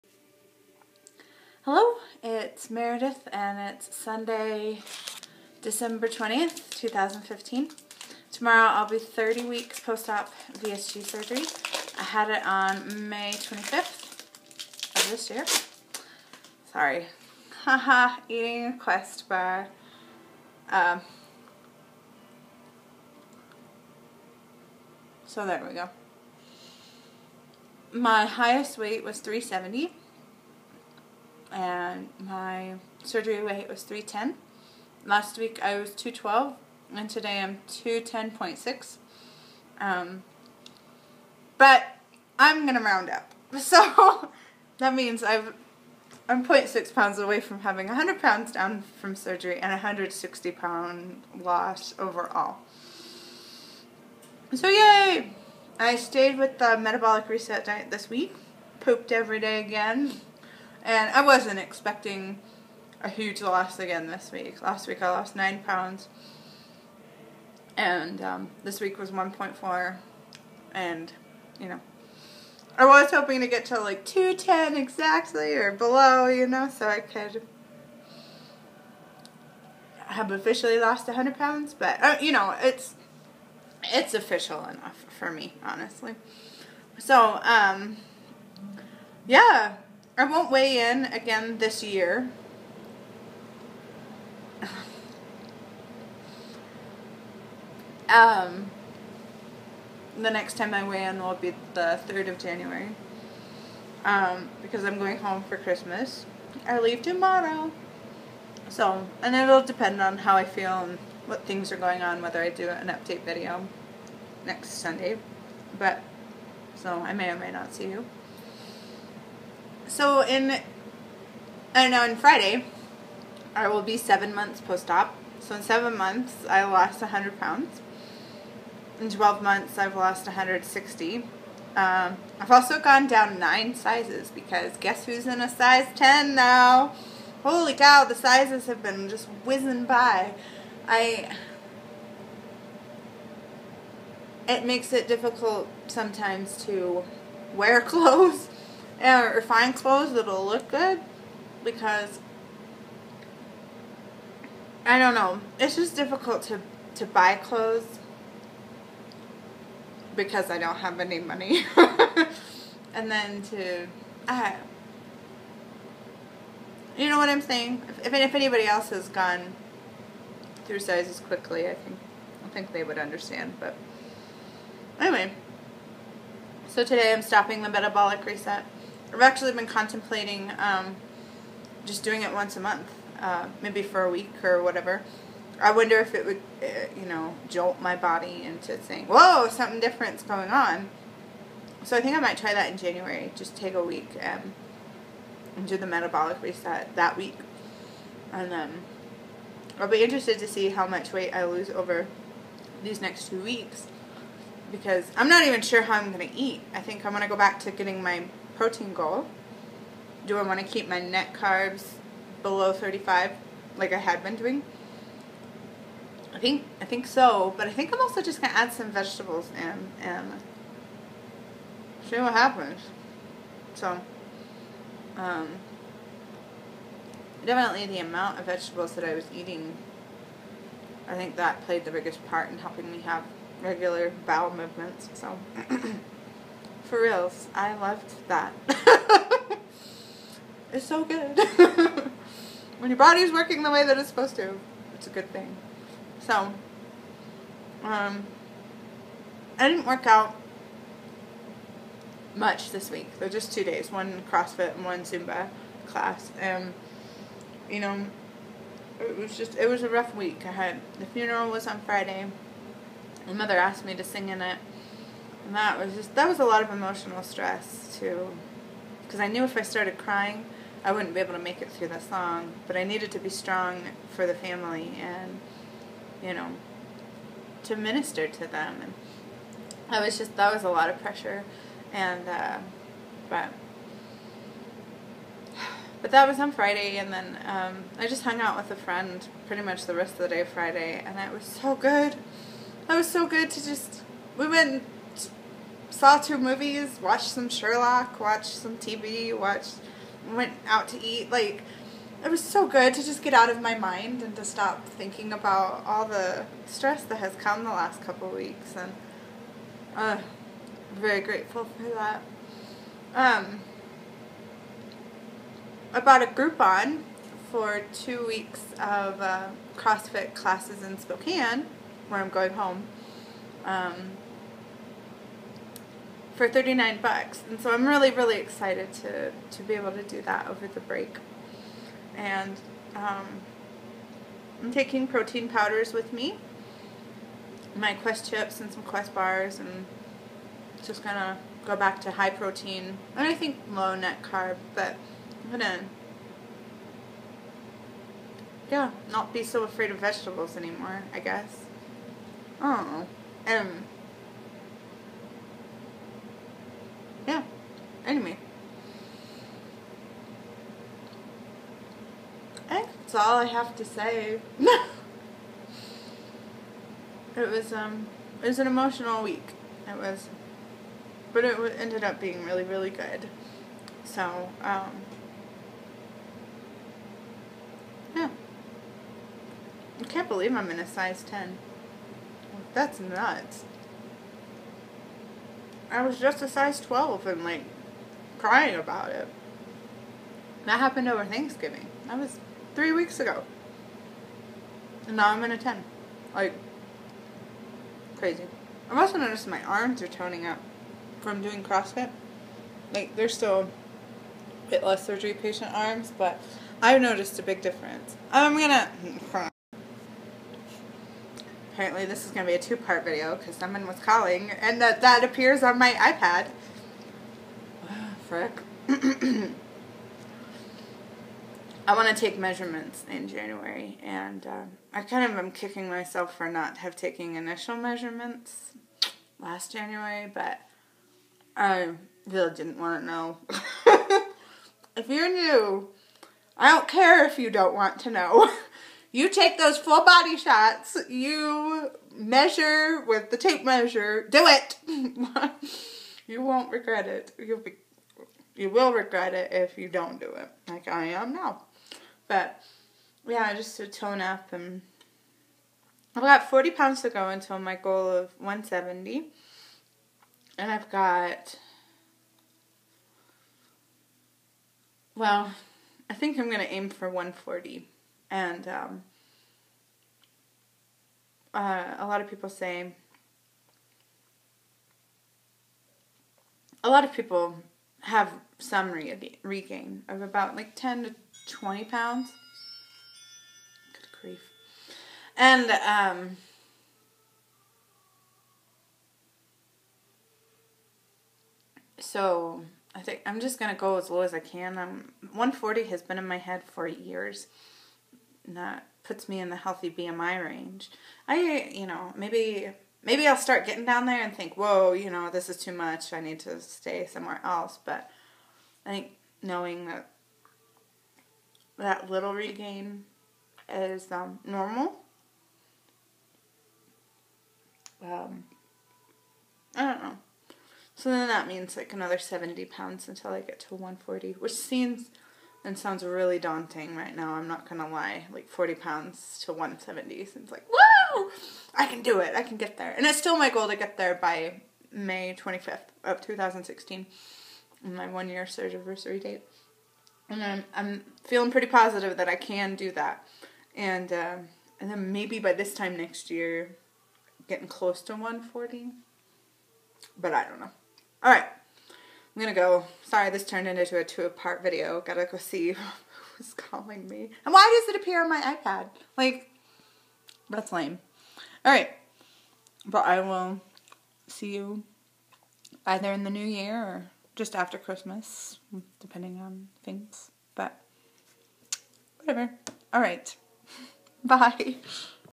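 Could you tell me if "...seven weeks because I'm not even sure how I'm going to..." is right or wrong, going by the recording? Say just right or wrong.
wrong.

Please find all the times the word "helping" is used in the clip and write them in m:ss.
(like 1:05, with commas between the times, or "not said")
3:52.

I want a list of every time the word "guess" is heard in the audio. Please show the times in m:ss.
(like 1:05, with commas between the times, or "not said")
2:14, 5:51.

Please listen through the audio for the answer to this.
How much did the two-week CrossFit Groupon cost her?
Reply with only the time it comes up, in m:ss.
5:26.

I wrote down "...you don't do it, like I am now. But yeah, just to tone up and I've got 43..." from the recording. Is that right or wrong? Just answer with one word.
wrong.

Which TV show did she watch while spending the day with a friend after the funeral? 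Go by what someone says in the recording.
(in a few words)
Sherlock.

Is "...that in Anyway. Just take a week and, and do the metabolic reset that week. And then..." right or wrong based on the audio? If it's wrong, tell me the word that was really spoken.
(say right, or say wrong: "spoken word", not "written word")
wrong: "January", not "Anyway".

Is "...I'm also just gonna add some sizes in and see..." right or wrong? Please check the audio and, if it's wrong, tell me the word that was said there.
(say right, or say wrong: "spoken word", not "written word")
wrong: "vegetables", not "sizes".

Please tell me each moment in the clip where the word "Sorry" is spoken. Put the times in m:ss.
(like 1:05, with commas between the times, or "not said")
0:16, 9:13.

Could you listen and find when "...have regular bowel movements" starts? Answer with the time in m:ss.
3:53.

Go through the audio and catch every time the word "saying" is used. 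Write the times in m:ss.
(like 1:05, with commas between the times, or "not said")
2:47, 3:08.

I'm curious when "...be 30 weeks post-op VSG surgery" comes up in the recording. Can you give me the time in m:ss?
0:08.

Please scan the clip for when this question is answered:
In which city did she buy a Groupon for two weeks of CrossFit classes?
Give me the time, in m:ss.
5:20.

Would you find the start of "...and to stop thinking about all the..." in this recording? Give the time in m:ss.
5:04.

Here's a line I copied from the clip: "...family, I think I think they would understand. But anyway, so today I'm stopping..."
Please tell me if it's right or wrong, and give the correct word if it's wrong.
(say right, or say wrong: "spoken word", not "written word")
wrong: "quickly", not "family".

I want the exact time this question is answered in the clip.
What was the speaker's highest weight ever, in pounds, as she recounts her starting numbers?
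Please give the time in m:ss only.
0:29.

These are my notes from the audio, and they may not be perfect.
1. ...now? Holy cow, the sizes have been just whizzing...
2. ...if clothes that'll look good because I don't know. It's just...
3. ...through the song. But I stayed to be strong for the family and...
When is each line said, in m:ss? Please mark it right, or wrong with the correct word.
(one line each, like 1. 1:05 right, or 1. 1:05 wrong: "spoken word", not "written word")
1. 2:16 right
2. 2:29 right
3. 4:31 wrong: "needed", not "stayed".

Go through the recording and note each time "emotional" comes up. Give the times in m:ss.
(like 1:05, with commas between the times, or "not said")
4:26, 6:08.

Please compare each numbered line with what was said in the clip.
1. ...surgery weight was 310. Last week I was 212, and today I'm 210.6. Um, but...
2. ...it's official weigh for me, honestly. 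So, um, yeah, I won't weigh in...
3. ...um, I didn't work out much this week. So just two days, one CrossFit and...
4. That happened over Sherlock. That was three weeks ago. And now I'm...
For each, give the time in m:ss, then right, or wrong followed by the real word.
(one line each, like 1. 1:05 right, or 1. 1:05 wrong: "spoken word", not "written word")
1. 0:33 right
2. 1:23 wrong: "enough", not "weigh"
3. 4:07 right
4. 6:30 wrong: "Thanksgiving", not "Sherlock".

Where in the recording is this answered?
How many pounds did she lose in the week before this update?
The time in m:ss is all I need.
1:05.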